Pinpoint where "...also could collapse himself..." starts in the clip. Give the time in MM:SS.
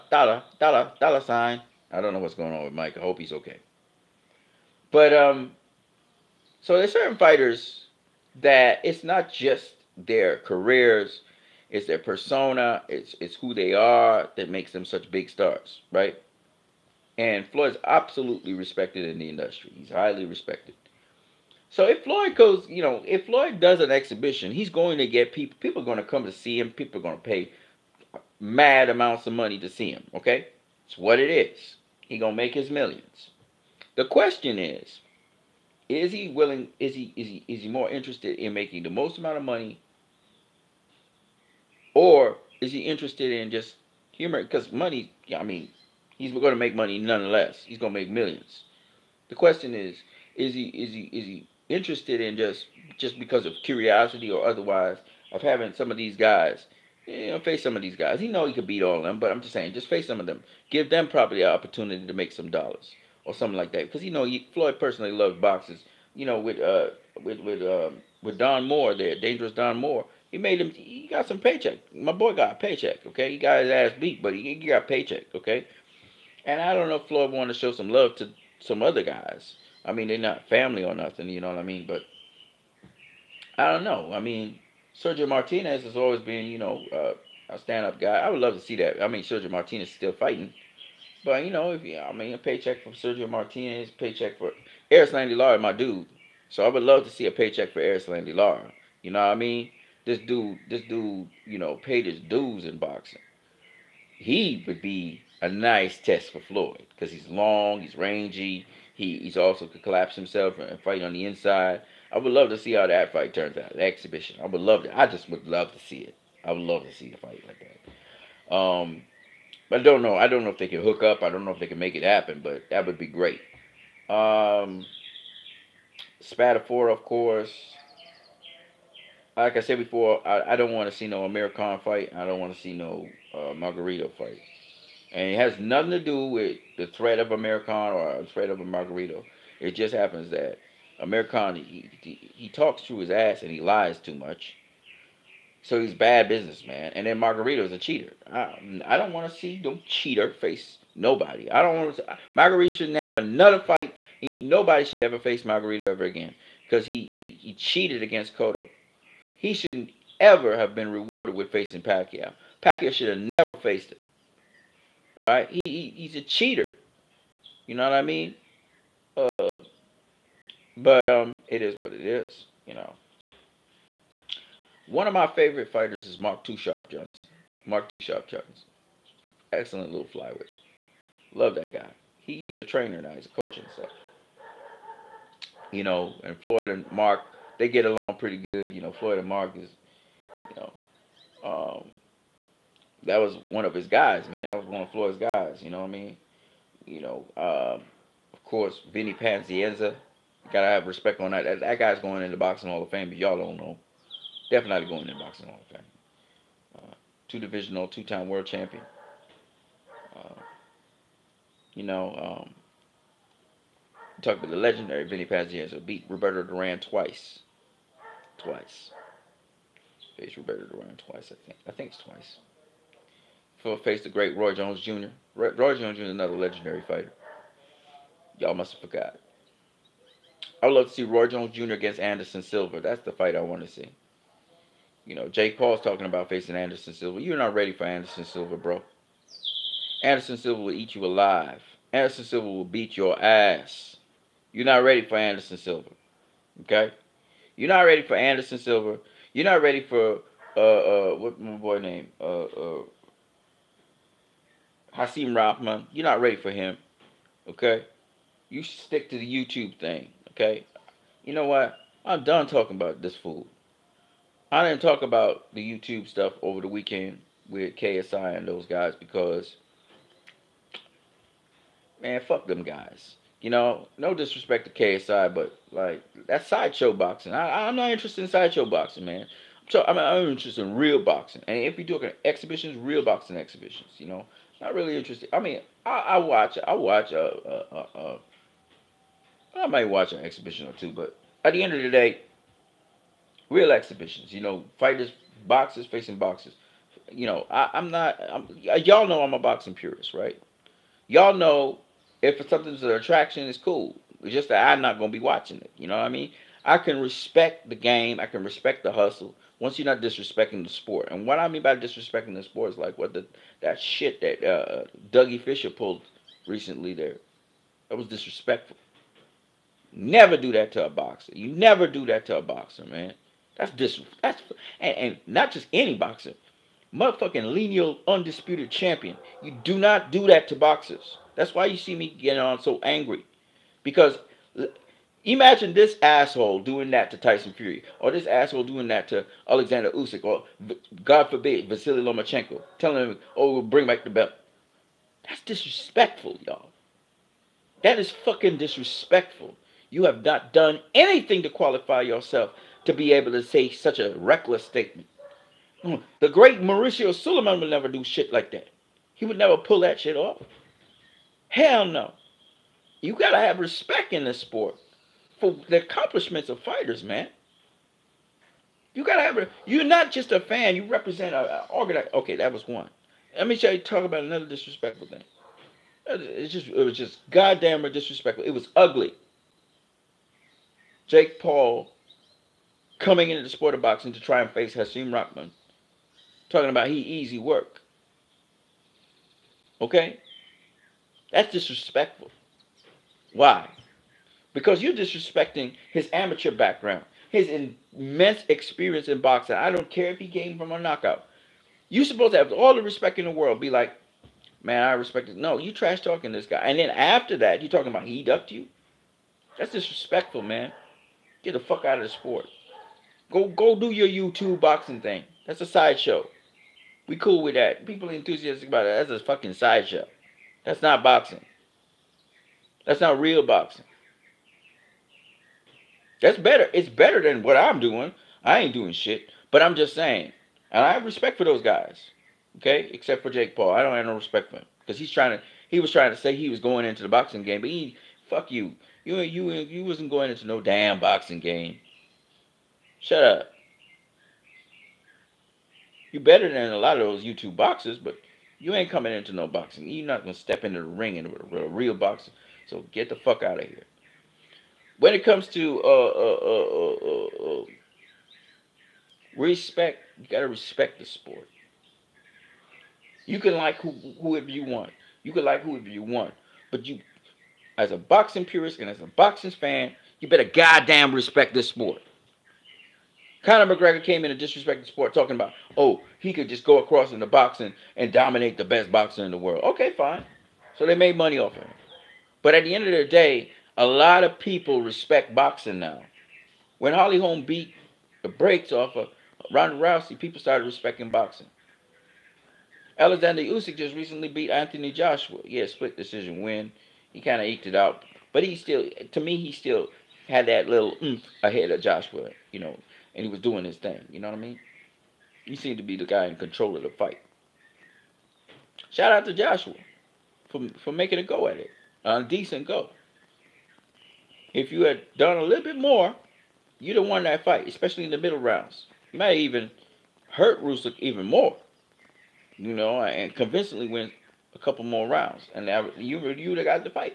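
01:49.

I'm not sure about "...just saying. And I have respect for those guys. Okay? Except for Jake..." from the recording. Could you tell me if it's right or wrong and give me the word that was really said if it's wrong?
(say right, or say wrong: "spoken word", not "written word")
right.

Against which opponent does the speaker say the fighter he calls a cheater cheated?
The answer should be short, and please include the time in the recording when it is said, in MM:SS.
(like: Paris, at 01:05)
Cotto, at 02:38.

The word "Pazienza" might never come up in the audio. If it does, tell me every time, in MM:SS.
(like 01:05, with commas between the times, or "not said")
03:19, 03:35.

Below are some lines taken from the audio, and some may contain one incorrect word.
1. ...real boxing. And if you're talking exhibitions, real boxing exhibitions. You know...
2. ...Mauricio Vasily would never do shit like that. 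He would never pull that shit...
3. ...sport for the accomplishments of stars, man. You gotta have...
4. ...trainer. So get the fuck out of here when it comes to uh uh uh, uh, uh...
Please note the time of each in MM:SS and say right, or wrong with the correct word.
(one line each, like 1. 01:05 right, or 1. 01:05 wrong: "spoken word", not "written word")
1. 04:40 right
2. 05:56 wrong: "Sulaiman", not "Vasily"
3. 06:04 wrong: "fighters", not "stars"
4. 07:31 wrong: "boxer", not "trainer".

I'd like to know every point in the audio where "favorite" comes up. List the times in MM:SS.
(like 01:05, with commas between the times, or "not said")
02:55.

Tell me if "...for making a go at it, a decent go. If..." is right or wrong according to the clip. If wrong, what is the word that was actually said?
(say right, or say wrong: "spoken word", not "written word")
right.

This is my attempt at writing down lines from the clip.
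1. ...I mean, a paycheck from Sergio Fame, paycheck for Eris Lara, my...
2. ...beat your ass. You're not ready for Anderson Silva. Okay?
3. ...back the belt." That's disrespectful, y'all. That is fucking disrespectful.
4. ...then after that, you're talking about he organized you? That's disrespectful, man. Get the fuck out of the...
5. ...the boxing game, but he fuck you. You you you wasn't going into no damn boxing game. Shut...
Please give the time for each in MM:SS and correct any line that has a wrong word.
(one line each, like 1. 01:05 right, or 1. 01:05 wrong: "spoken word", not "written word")
1. 01:31 wrong: "Martinez", not "Fame"
2. 04:02 right
3. 05:43 right
4. 06:46 wrong: "ducked", not "organized"
5. 07:17 right.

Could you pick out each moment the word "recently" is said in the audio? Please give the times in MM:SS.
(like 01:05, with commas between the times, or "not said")
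05:16, 08:13.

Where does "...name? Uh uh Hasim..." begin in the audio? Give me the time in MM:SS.
04:11.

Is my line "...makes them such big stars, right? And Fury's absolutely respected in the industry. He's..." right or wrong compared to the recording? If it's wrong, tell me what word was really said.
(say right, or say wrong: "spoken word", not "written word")
wrong: "Floyd", not "Fury".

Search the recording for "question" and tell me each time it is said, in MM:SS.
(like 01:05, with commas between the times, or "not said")
00:34, 00:49.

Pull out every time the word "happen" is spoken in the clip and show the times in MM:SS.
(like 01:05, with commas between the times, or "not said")
02:02, 02:19.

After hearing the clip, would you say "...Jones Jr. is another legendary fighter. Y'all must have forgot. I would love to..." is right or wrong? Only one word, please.
right.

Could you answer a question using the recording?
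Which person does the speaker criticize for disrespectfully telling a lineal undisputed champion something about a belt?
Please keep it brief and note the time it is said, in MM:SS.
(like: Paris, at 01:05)
Dougie Fisher, at 05:15.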